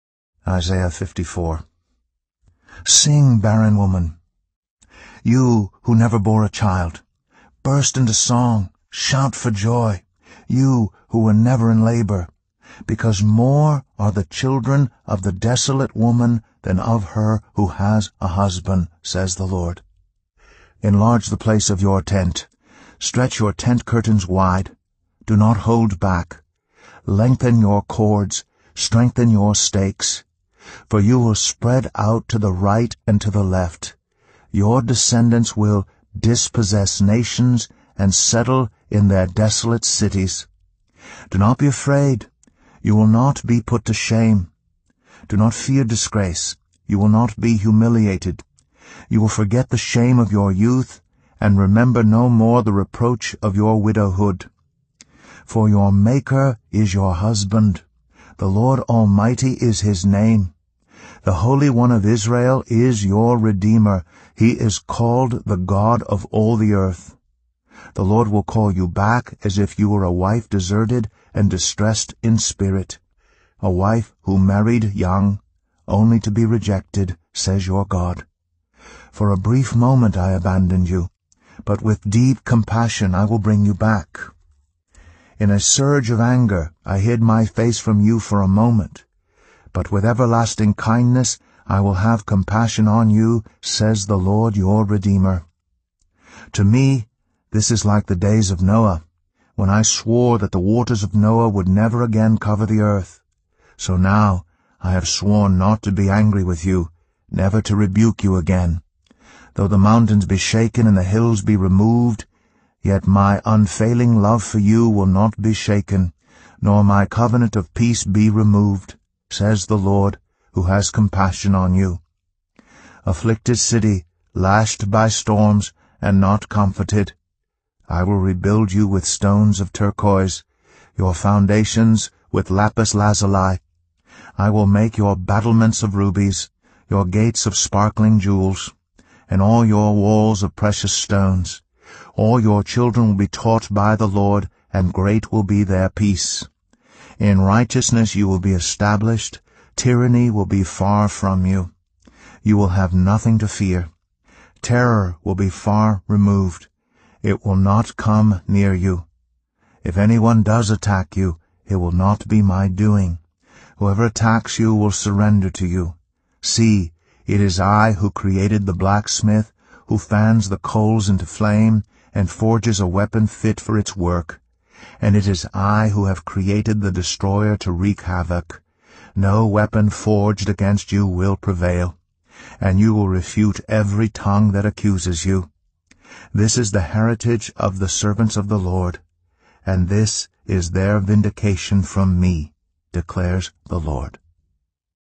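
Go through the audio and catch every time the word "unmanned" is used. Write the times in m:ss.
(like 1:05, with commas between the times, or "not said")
not said.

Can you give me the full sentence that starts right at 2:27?
In righteousness you will be established, tyranny will be far from you.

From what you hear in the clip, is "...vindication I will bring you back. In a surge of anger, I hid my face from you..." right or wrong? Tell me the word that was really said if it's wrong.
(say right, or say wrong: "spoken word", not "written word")
wrong: "compassion", not "vindication".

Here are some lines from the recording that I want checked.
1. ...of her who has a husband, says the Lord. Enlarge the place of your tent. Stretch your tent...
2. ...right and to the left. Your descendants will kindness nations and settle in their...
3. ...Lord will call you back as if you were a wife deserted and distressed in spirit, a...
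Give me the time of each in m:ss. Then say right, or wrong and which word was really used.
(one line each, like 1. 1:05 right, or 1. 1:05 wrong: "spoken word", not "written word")
1. 0:16 right
2. 0:32 wrong: "dispossess", not "kindness"
3. 1:08 right.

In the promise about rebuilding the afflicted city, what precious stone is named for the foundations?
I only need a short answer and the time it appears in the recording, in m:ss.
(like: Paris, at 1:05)
lapis lazuli, at 2:12.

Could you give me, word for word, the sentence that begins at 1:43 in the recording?
So now I have sworn not to be angry with you, never to rebuke you again.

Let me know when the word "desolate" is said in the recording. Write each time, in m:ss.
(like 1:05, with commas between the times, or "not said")
0:15, 0:39.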